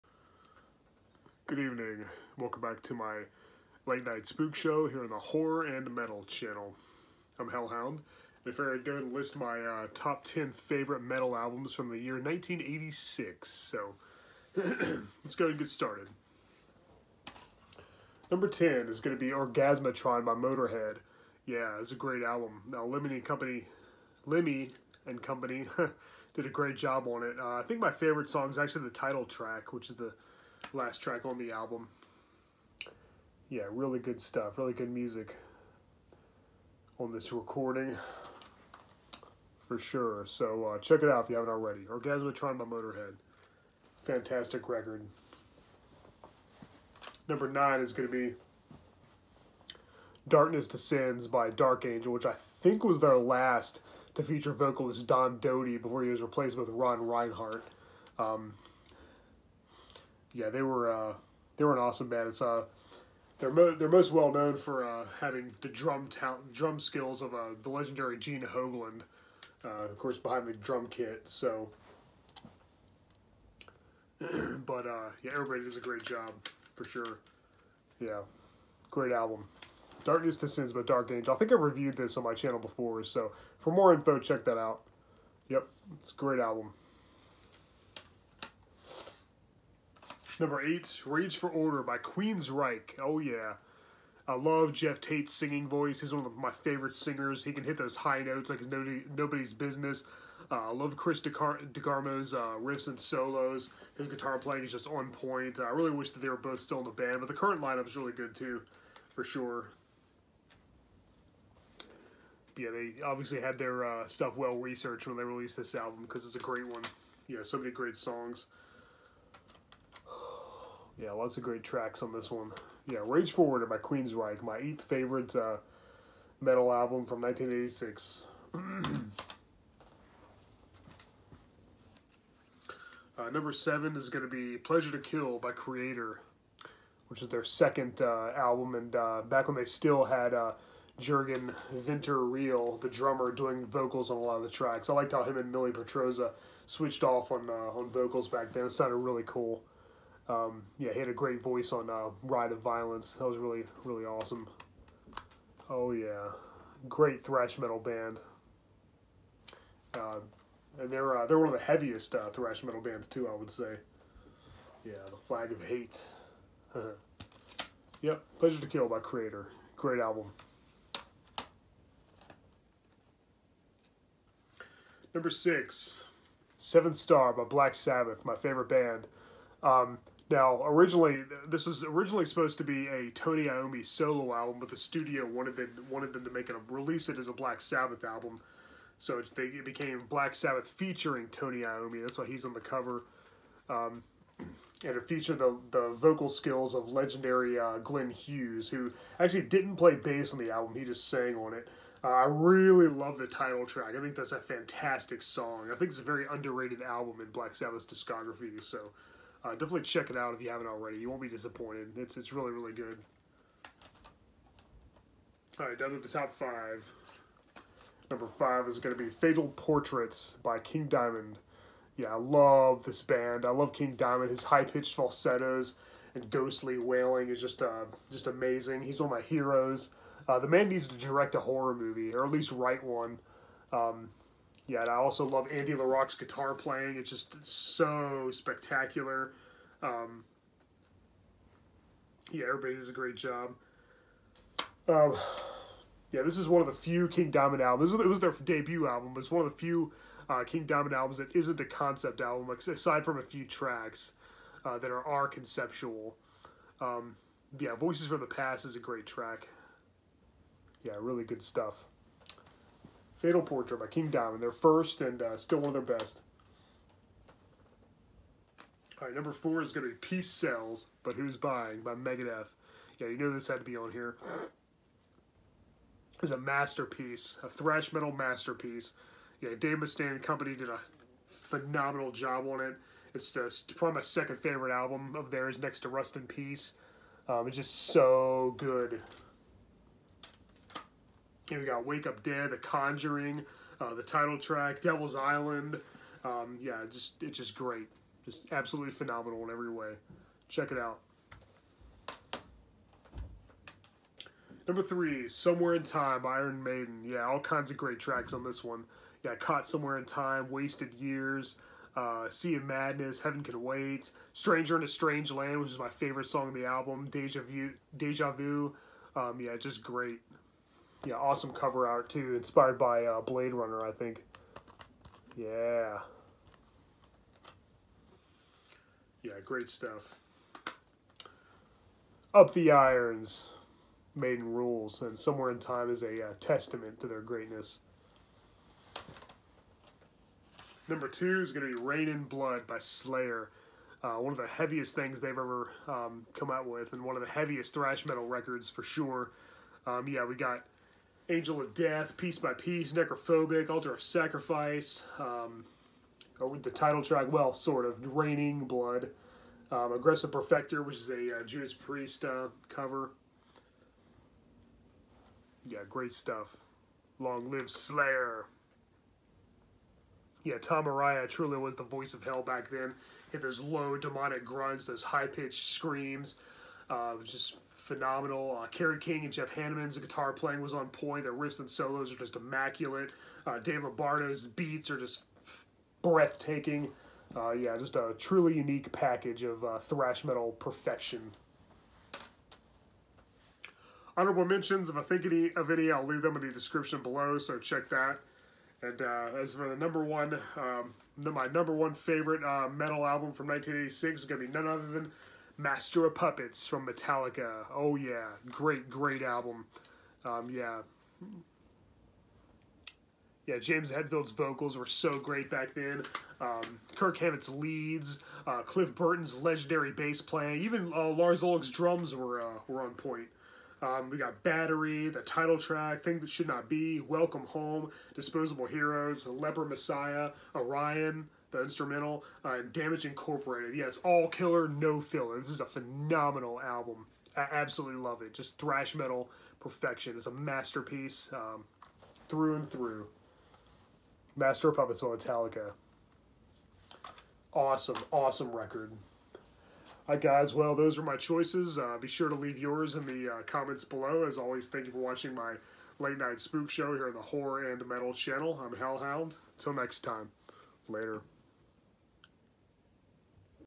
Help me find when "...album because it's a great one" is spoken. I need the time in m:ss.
1:55.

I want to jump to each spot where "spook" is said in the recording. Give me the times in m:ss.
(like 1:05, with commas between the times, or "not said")
0:04, 7:36.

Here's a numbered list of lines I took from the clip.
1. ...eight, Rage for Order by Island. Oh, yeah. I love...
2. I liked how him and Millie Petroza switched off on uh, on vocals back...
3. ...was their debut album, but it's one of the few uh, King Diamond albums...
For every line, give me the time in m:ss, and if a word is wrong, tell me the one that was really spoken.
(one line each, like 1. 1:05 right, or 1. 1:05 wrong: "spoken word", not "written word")
1. 1:30 wrong: "Queensryche", not "Island"
2. 2:24 right
3. 4:08 right.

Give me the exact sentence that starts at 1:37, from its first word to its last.
He can hit those high notes like it's nobody, nobody's business.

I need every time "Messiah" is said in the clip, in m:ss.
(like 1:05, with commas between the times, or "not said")
7:09.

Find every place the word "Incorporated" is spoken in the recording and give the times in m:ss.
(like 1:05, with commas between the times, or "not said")
7:13.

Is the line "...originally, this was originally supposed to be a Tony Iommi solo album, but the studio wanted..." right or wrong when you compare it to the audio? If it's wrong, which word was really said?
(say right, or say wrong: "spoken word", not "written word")
right.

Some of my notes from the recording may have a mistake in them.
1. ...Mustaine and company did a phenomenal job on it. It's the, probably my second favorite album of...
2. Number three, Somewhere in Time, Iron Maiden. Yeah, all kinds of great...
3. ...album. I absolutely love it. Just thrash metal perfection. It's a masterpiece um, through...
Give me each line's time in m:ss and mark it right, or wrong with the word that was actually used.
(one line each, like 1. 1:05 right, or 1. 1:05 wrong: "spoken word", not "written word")
1. 4:39 right
2. 5:04 right
3. 7:16 right.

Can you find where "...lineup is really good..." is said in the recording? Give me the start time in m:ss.
1:47.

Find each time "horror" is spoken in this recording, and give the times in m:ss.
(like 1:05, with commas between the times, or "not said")
0:05, 3:51, 7:37.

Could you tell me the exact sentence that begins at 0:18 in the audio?
Number 10 is going to be Orgasmatron by Motorhead.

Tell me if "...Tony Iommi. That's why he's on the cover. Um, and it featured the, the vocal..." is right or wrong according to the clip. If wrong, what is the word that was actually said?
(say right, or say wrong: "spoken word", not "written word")
right.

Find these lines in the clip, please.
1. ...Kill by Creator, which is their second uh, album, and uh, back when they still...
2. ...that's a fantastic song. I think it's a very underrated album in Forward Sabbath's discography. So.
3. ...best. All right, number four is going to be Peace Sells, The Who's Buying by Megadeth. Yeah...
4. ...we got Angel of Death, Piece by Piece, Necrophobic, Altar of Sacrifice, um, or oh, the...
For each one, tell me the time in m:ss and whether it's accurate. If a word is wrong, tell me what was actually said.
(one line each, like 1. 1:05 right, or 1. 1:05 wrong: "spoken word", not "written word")
1. 2:14 right
2. 3:24 wrong: "Black", not "Forward"
3. 4:25 wrong: "But", not "The"
4. 5:50 right.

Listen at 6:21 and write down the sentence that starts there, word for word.
Their riffs and solos are just immaculate.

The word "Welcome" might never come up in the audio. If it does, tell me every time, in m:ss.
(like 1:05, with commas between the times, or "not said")
0:02, 7:06.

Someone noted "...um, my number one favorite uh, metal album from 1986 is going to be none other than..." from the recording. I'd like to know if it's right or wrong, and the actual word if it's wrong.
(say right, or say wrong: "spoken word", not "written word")
right.